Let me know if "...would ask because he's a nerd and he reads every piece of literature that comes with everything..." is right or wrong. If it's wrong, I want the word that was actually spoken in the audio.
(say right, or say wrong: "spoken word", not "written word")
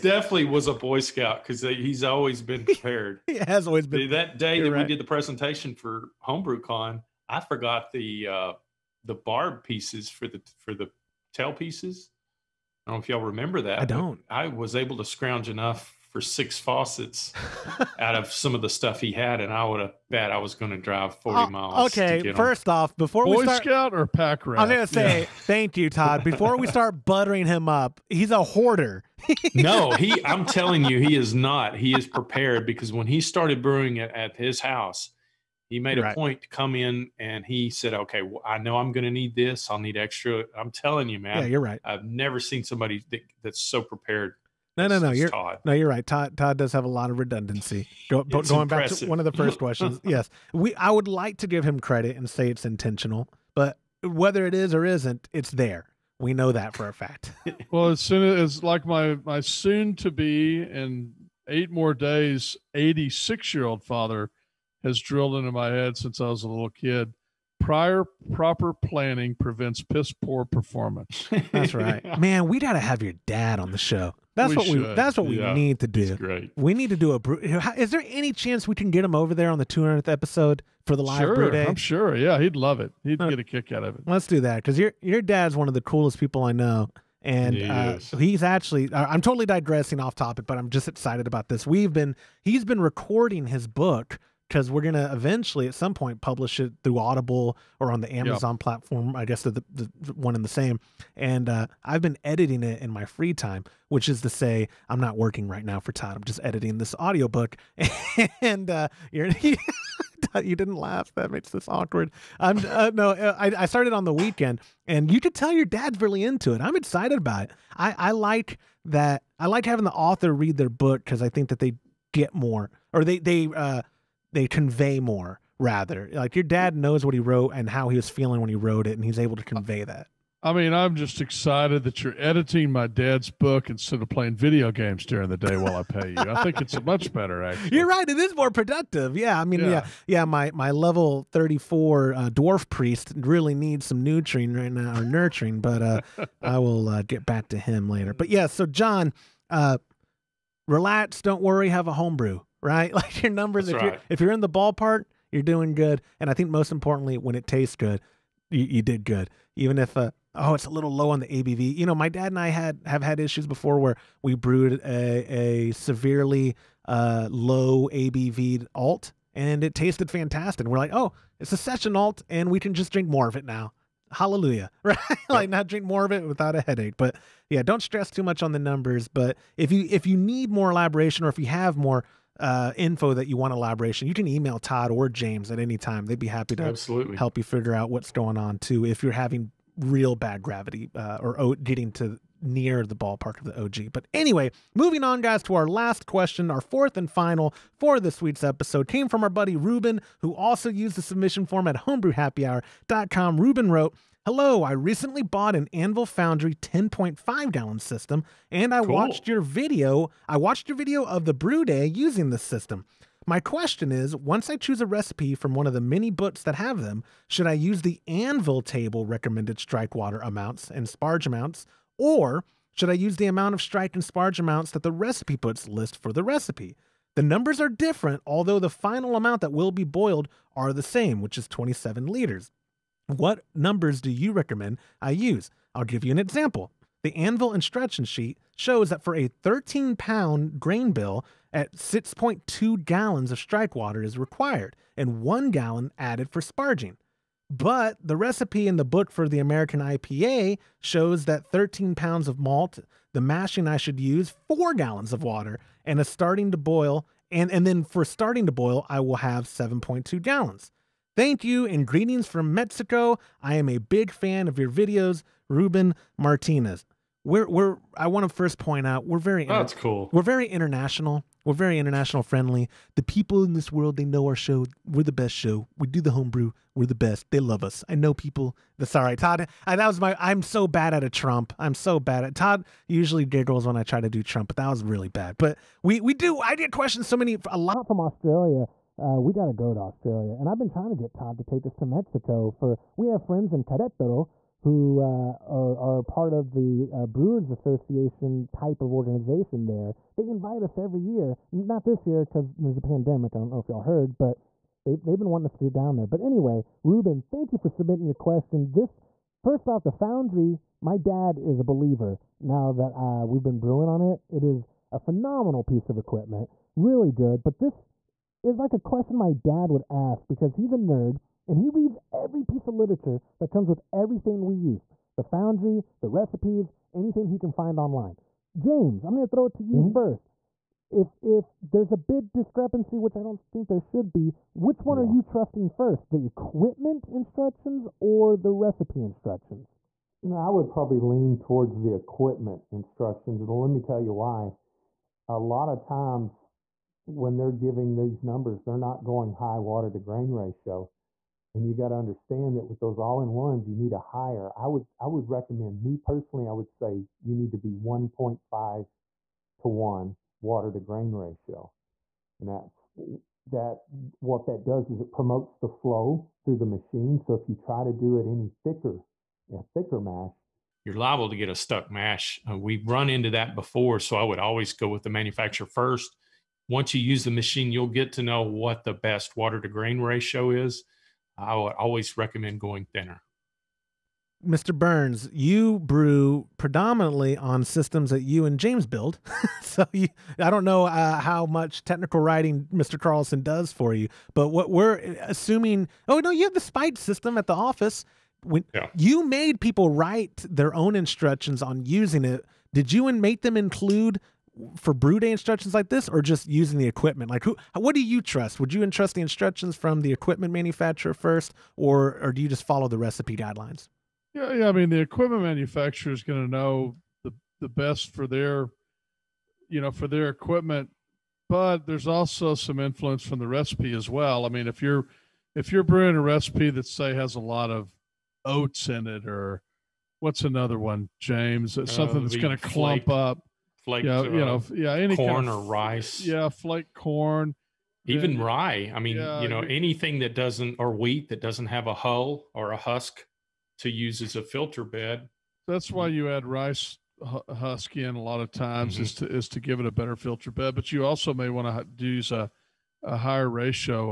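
right.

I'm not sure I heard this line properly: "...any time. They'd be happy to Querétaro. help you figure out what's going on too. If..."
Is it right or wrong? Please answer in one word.
wrong.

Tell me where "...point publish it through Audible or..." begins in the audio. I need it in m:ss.
1:35.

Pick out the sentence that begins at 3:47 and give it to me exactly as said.
The numbers are different, although the final amount that will be boiled are the same, which is 27 liters.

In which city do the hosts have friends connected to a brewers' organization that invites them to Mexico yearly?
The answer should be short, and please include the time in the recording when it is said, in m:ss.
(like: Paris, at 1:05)
Querétaro, at 4:53.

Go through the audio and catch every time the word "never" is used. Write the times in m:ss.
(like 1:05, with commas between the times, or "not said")
0:42.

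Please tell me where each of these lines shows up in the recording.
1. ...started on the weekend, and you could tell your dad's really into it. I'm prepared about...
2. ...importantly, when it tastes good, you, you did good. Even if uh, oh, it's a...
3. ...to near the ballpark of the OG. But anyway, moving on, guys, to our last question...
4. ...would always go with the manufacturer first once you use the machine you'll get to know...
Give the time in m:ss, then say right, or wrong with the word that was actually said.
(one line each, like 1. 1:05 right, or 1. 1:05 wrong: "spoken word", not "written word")
1. 1:53 wrong: "excited", not "prepared"
2. 2:36 right
3. 3:11 right
4. 6:14 right.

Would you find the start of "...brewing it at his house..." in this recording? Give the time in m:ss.
0:33.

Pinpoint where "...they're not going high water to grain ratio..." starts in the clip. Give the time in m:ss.
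5:48.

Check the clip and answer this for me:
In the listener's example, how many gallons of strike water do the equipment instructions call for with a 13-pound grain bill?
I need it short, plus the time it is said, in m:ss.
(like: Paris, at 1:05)
6.2 gallons, at 4:01.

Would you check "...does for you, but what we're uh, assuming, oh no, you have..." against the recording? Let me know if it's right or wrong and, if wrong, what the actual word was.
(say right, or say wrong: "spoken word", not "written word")
right.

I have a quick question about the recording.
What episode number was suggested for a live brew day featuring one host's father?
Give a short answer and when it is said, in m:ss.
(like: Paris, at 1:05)
200th, at 1:19.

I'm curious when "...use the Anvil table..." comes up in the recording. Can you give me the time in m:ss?
3:37.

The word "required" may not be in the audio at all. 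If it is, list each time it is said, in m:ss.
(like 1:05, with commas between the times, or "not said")
4:04.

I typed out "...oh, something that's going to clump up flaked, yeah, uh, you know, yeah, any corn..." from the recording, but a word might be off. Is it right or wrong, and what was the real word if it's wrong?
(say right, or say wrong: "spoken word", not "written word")
right.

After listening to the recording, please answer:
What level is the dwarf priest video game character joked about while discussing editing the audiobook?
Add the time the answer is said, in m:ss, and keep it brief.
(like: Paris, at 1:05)
34, at 2:21.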